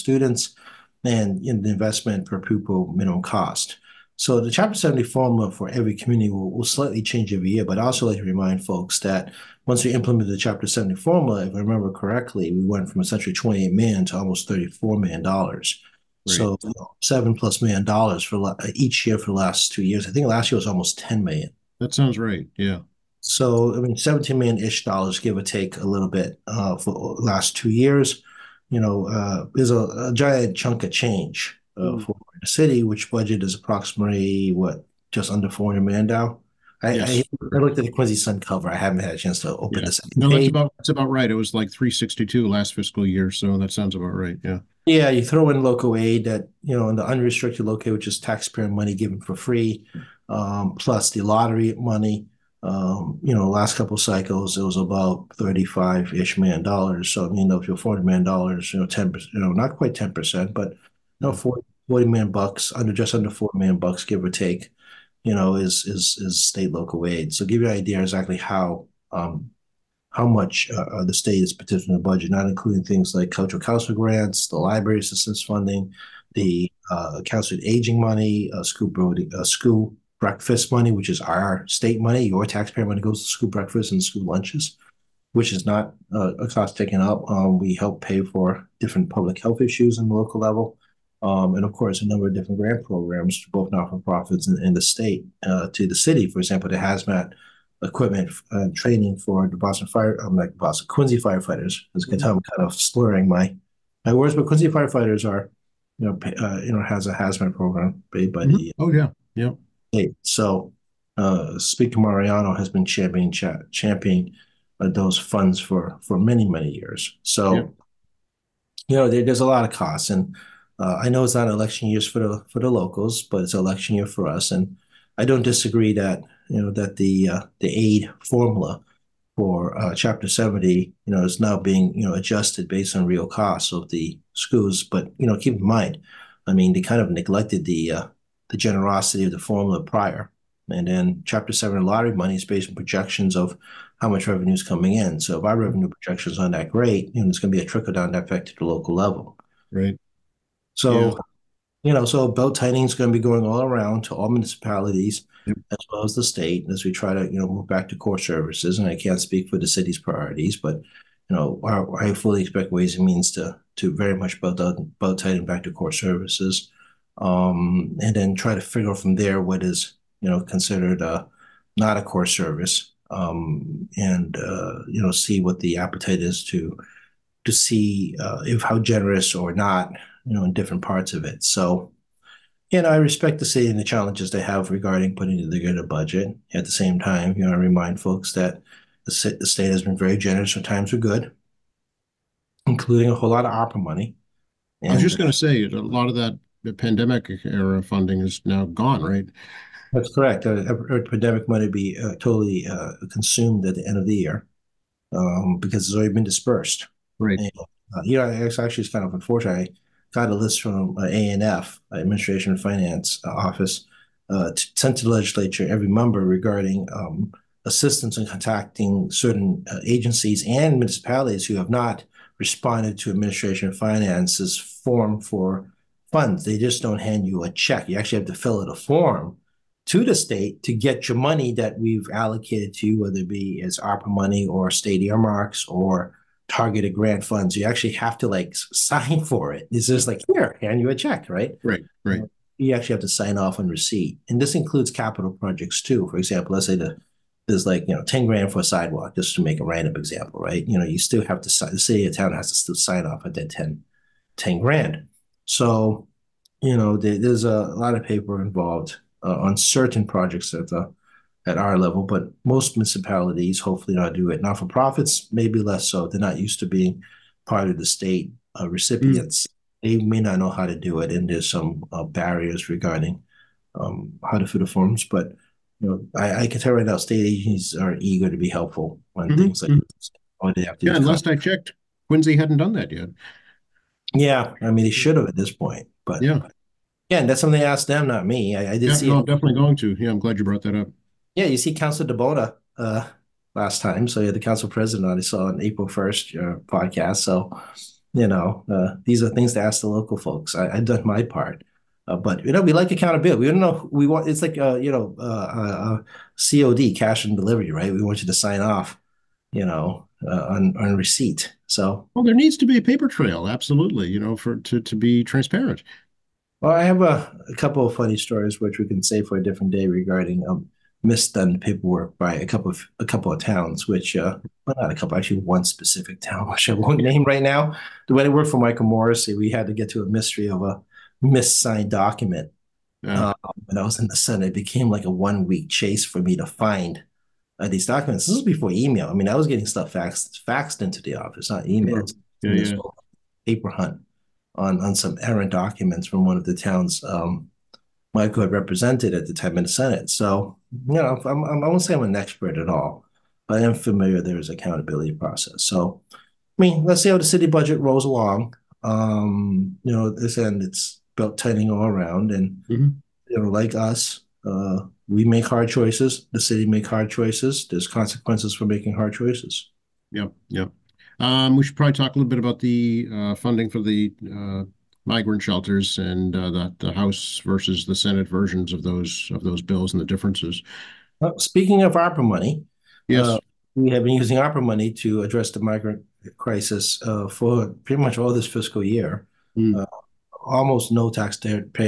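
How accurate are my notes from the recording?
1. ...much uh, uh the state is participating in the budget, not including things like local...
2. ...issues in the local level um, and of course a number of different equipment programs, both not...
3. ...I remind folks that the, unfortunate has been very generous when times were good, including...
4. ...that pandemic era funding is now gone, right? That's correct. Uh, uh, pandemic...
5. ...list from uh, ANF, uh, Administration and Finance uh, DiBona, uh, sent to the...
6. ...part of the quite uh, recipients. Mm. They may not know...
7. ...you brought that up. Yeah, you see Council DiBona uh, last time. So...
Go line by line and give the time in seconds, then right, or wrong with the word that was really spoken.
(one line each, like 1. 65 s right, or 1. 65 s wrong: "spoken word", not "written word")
1. 70 s wrong: "cultural", not "local"
2. 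89 s wrong: "grant", not "equipment"
3. 187 s wrong: "state", not "unfortunate"
4. 196 s right
5. 210 s wrong: "Office", not "DiBona"
6. 267 s wrong: "state", not "quite"
7. 290 s right.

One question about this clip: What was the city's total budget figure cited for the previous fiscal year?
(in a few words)
362.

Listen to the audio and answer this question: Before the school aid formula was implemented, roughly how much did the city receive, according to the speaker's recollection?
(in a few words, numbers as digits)
28 million.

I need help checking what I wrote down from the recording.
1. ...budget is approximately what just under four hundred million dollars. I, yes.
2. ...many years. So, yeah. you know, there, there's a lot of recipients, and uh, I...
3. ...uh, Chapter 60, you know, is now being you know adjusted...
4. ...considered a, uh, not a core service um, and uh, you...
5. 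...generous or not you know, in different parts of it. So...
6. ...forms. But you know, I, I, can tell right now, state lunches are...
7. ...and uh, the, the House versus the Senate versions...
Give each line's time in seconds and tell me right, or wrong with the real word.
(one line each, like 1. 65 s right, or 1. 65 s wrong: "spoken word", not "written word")
1. 33 s right
2. 116 s wrong: "costs", not "recipients"
3. 129 s wrong: "70", not "60"
4. 170 s right
5. 178 s right
6. 274 s wrong: "agencies", not "lunches"
7. 375 s right.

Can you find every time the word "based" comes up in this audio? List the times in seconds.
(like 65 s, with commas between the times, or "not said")
132 s, 142 s.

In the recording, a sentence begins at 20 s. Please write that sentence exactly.
I think last year was almost ten million.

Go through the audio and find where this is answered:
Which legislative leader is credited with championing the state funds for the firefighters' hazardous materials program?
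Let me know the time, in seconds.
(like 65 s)
111 s.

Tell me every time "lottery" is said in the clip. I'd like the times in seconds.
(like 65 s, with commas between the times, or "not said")
51 s, 141 s.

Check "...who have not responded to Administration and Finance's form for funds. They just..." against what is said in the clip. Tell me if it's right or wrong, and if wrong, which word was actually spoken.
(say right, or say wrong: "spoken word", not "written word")
right.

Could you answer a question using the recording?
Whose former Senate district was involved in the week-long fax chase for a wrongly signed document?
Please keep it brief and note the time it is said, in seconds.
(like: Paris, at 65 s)
Michael Morrissey, at 328 s.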